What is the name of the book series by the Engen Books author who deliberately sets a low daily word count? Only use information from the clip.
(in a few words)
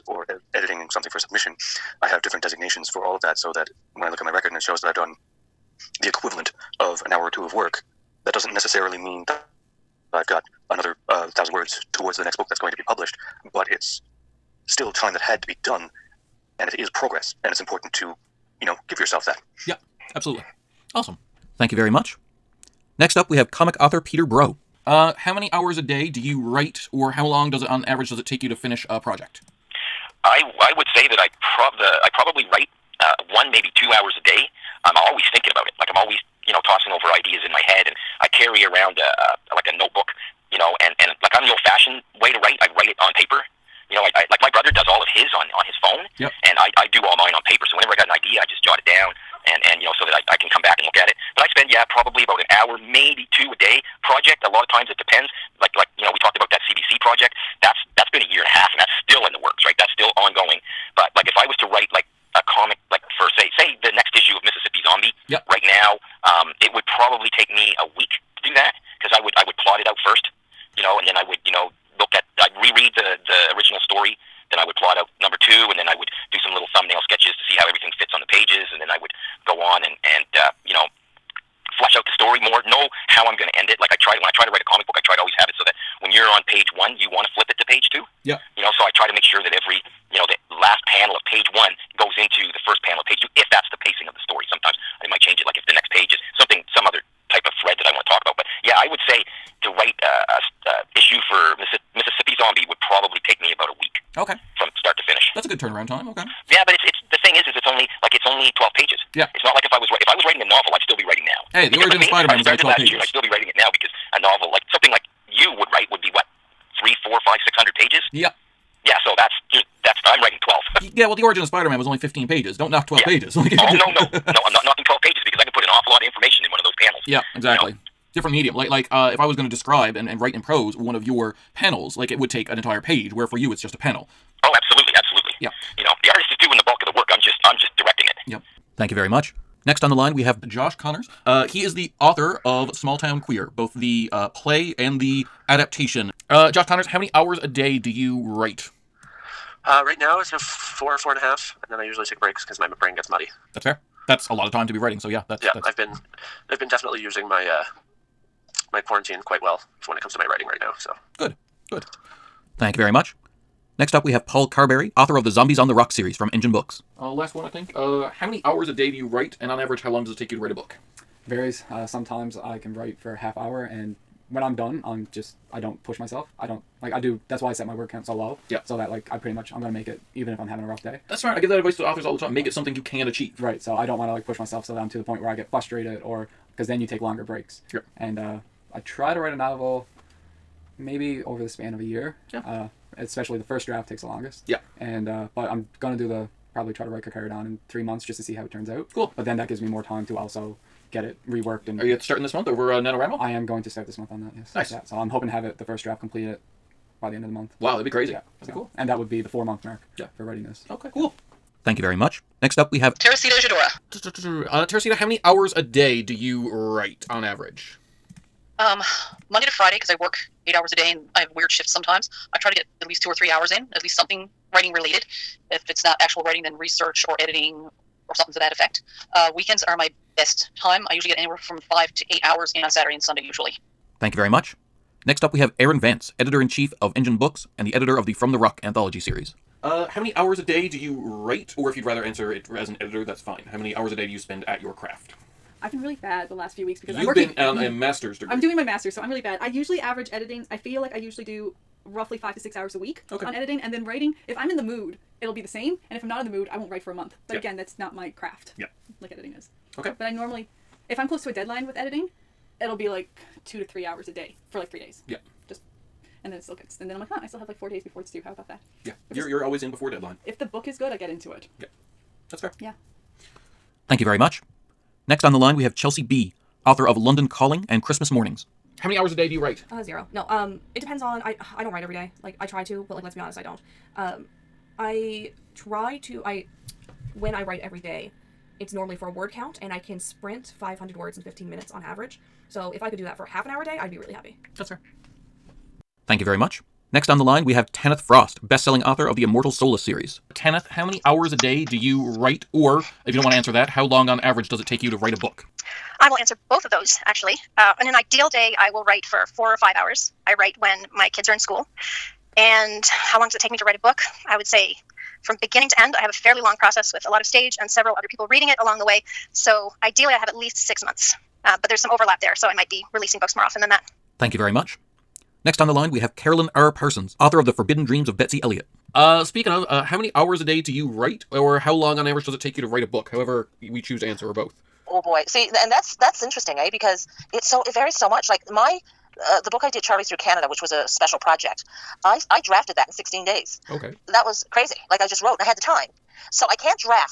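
Zombies on the Rock.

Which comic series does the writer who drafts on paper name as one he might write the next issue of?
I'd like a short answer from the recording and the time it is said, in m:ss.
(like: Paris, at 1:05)
Mississippi Zombie, at 1:04.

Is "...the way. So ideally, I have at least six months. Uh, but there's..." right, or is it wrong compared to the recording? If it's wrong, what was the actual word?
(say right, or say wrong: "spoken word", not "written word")
right.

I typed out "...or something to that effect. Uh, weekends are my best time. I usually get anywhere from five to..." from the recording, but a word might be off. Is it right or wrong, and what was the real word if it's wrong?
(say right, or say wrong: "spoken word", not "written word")
right.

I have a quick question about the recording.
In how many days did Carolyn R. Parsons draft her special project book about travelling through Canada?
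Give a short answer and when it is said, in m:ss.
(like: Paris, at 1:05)
16, at 5:42.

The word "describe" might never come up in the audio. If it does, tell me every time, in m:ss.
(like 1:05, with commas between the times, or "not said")
2:09.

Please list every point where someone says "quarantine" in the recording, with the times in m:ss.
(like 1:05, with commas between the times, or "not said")
2:38.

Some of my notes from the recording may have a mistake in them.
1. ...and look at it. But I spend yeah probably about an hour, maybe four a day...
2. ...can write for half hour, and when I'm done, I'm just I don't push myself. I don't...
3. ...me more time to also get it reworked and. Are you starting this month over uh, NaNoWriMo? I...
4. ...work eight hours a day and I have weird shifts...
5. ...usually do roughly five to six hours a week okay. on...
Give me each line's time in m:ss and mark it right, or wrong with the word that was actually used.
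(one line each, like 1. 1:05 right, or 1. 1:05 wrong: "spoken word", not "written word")
1. 0:50 wrong: "two", not "four"
2. 2:52 right
3. 3:19 right
4. 3:39 right
5. 4:10 right.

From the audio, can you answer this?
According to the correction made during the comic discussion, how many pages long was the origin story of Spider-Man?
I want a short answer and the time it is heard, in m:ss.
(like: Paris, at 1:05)
15, at 2:01.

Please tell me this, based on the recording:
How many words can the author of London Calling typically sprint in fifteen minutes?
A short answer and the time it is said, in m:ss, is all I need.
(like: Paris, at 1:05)
500, at 4:50.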